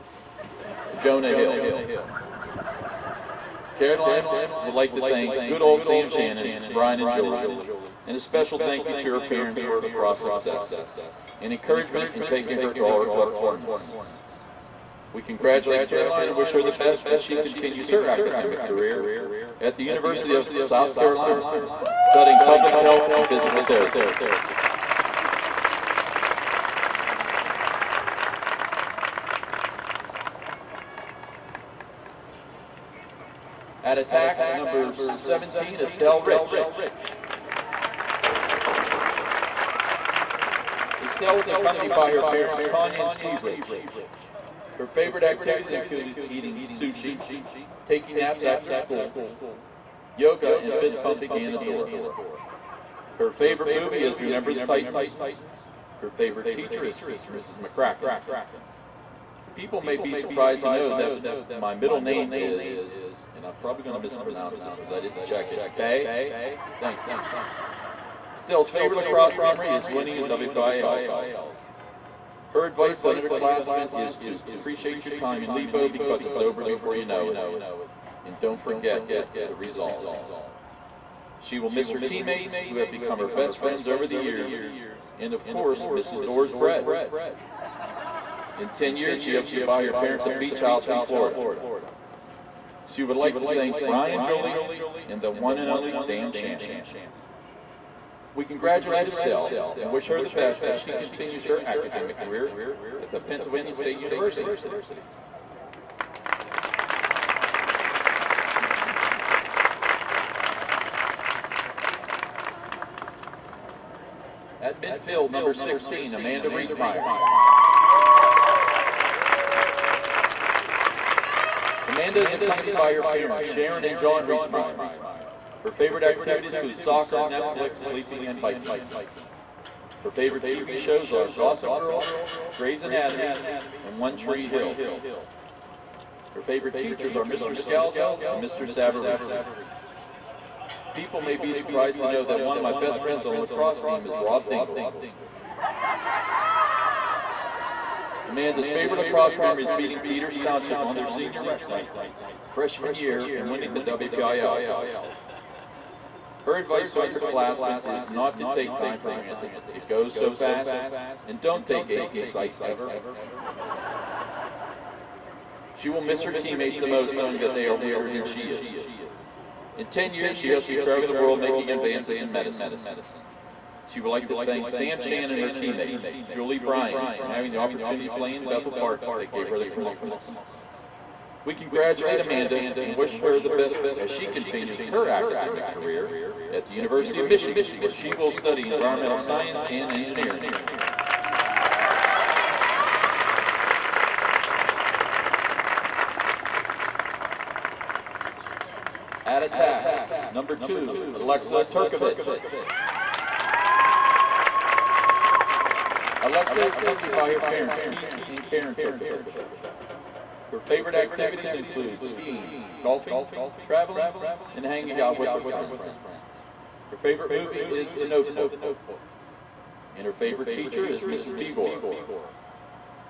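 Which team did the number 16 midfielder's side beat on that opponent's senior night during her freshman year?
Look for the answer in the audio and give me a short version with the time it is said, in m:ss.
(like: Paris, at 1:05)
Peters Township, at 2:29.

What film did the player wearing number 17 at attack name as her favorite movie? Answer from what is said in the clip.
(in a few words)
Remember the Titans.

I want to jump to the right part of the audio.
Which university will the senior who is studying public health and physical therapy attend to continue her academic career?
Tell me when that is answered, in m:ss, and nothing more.
0:19.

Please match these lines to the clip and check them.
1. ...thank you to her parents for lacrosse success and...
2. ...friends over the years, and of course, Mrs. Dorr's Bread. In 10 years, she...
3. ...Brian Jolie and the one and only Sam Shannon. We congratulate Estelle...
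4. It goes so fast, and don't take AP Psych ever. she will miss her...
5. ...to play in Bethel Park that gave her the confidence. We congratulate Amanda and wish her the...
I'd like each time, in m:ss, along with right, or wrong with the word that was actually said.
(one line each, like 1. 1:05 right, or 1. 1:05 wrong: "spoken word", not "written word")
1. 0:08 right
2. 1:23 right
3. 1:33 right
4. 2:39 right
5. 2:58 right.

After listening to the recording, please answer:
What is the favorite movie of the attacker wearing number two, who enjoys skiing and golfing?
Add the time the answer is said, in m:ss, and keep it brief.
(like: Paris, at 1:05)
The Notebook, at 3:37.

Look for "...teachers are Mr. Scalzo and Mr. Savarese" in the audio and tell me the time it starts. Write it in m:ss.
2:16.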